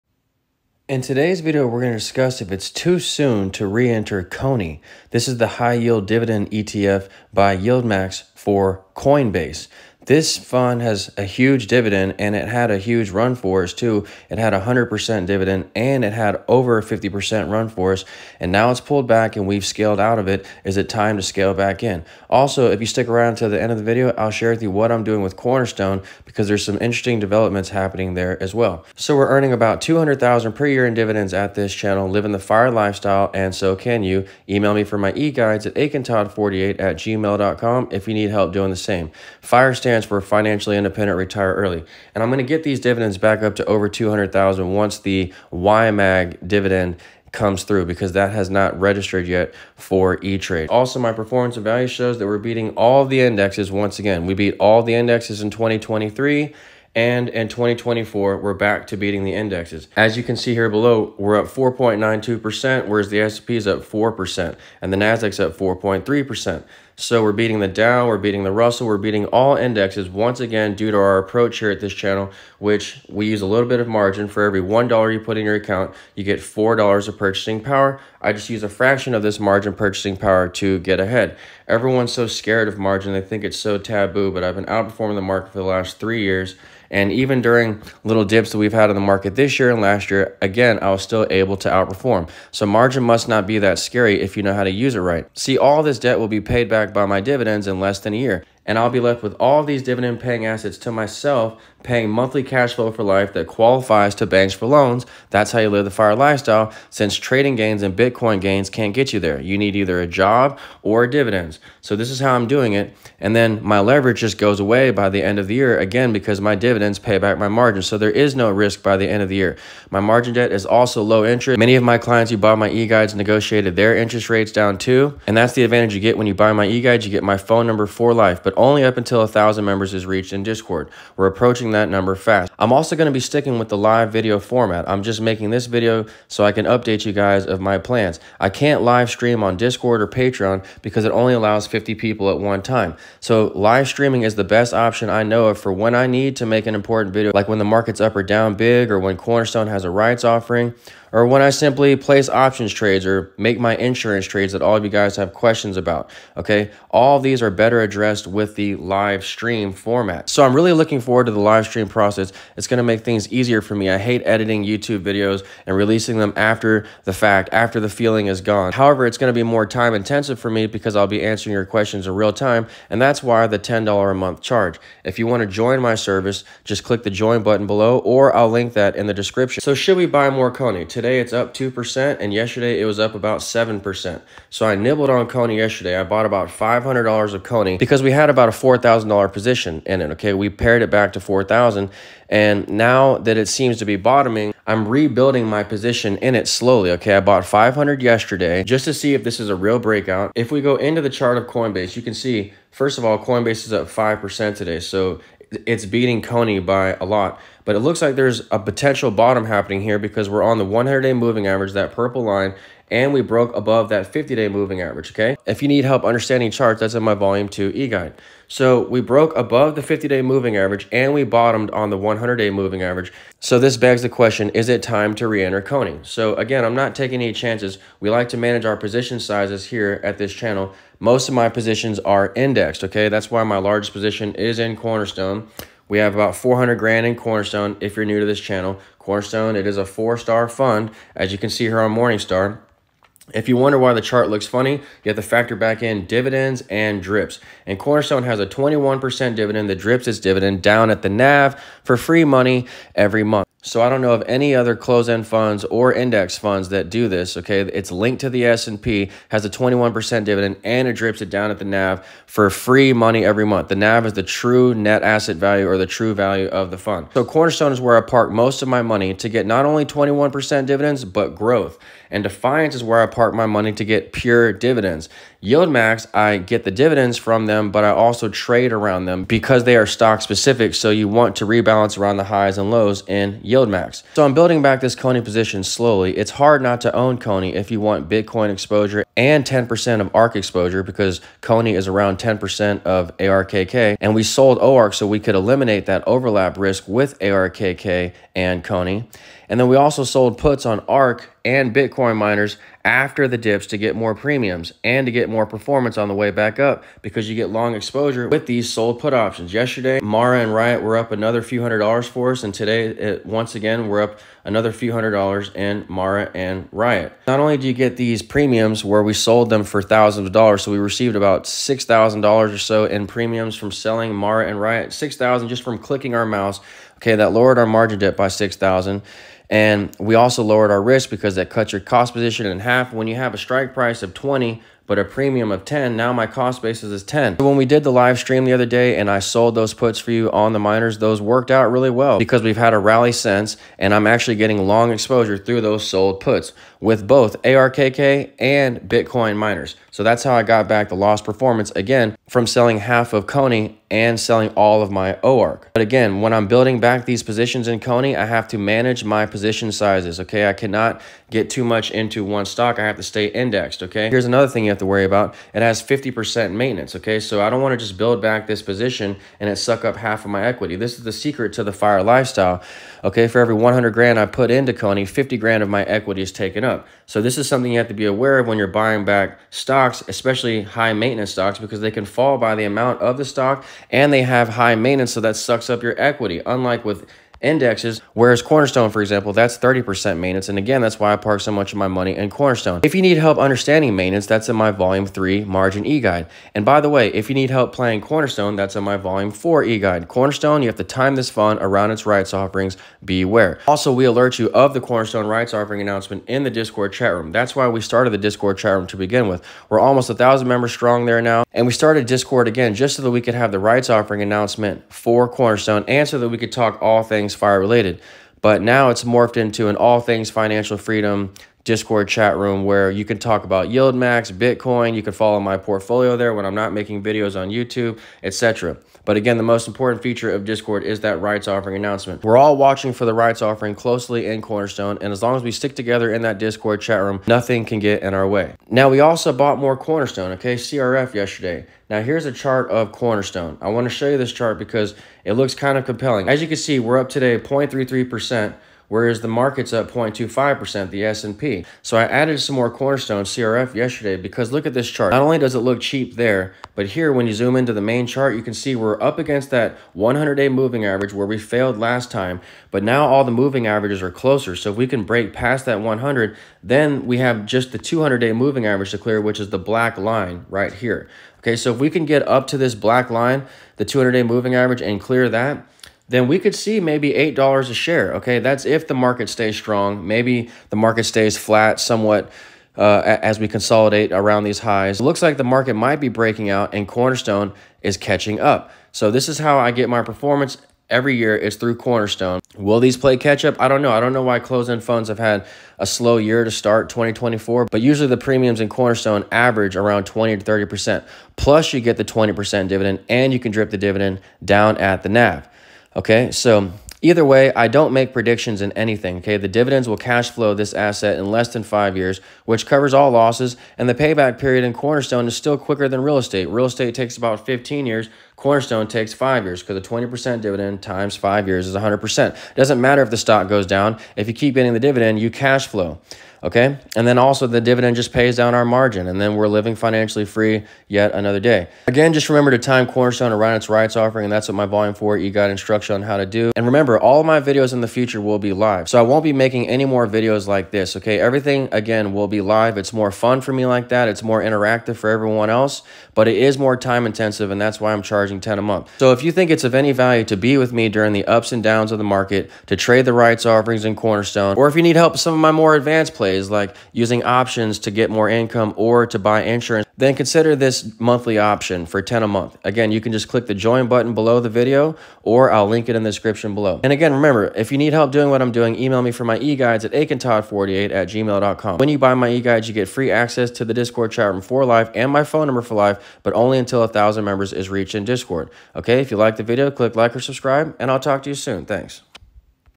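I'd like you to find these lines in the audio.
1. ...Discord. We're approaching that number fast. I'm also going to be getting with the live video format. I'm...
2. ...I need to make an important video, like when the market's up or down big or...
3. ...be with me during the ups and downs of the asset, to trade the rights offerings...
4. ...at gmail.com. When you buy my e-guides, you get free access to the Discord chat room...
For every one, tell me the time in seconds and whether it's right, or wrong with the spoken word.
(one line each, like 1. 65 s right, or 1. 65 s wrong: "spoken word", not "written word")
1. 130 s wrong: "sticking", not "getting"
2. 145 s right
3. 550 s wrong: "market", not "asset"
4. 570 s right.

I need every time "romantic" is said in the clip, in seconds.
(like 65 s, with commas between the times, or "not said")
not said.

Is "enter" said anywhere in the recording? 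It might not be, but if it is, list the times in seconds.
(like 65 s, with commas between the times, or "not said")
3 s, 225 s.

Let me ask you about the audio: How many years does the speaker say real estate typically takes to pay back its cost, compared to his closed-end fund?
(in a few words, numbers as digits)
15.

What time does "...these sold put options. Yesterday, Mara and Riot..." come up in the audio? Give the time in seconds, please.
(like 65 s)
308 s.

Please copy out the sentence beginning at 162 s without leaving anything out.
It's gonna make things easier for me.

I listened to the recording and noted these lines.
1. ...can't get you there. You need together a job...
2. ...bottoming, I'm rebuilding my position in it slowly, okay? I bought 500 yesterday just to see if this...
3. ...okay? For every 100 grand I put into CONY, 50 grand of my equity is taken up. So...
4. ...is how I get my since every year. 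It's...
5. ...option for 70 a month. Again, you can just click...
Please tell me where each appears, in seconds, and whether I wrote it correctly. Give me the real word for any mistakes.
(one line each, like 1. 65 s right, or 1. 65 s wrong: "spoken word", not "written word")
1. 108 s wrong: "either", not "together"
2. 193 s right
3. 373 s right
4. 489 s wrong: "performance", not "since"
5. 561 s wrong: "10", not "70".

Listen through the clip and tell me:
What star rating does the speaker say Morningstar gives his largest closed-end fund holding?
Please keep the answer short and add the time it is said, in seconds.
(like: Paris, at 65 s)
four-star, at 239 s.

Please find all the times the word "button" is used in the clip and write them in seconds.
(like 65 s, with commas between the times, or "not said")
177 s, 563 s.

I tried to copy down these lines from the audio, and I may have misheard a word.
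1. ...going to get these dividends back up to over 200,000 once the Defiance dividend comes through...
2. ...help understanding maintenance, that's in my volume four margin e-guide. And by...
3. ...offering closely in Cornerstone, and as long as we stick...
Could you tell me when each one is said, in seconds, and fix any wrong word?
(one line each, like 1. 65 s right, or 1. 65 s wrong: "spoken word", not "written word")
1. 42 s wrong: "YMAG", not "Defiance"
2. 393 s wrong: "three", not "four"
3. 433 s right.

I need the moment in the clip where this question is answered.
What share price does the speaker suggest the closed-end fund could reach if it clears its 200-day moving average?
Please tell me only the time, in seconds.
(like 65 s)
477 s.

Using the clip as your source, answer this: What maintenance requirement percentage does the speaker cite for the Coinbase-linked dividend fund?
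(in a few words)
50%.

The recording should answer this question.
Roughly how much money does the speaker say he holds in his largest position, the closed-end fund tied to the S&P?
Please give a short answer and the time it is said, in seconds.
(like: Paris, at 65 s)
400 grand, at 236 s.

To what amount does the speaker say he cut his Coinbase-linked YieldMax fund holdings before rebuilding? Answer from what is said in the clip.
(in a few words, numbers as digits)
4000.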